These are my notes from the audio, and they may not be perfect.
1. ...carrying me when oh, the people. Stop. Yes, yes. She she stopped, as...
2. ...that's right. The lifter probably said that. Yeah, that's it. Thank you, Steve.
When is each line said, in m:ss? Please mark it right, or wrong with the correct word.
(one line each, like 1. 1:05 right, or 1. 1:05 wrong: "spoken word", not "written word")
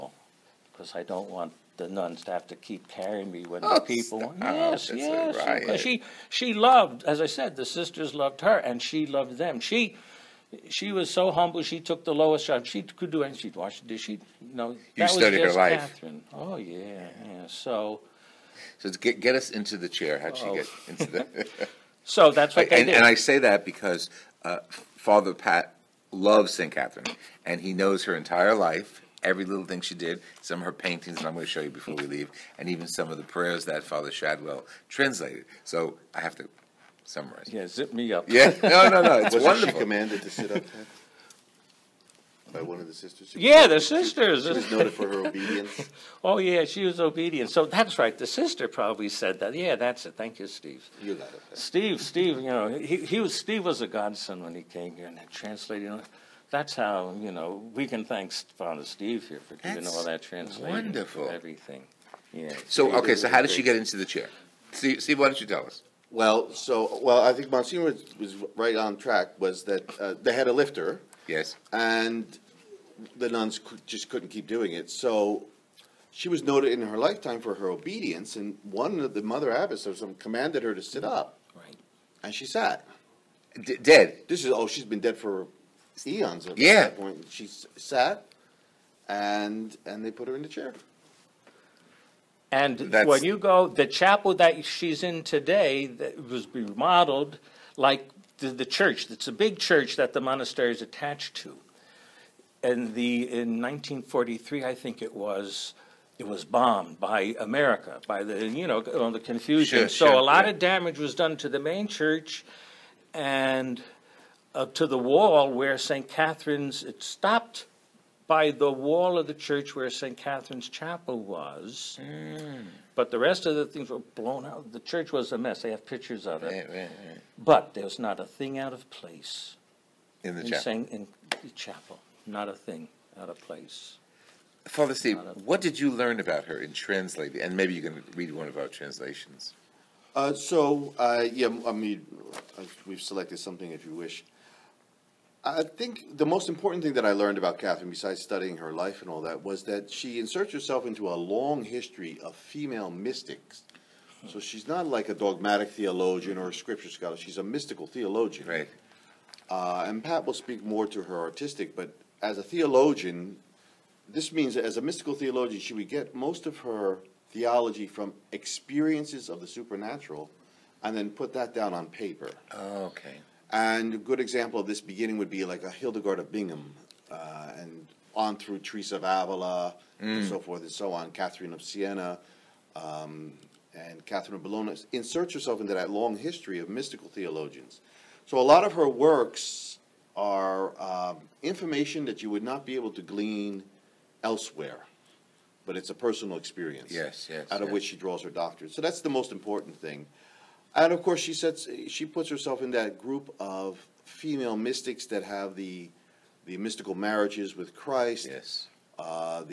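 1. 0:02 wrong: "loved", not "stopped"
2. 0:47 wrong: "sister", not "lifter".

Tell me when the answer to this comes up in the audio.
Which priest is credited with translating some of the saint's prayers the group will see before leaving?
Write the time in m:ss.
0:33.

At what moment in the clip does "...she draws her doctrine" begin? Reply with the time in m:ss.
3:17.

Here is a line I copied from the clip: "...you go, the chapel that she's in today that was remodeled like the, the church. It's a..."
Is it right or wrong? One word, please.
right.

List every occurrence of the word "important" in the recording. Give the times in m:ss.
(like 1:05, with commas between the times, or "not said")
2:26, 3:19.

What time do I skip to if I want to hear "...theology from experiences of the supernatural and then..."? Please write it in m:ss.
2:47.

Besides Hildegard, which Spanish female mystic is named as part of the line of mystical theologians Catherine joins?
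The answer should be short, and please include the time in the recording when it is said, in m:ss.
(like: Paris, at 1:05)
Teresa of Avila, at 2:58.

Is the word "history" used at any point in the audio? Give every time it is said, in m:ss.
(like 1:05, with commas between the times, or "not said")
2:31, 3:06.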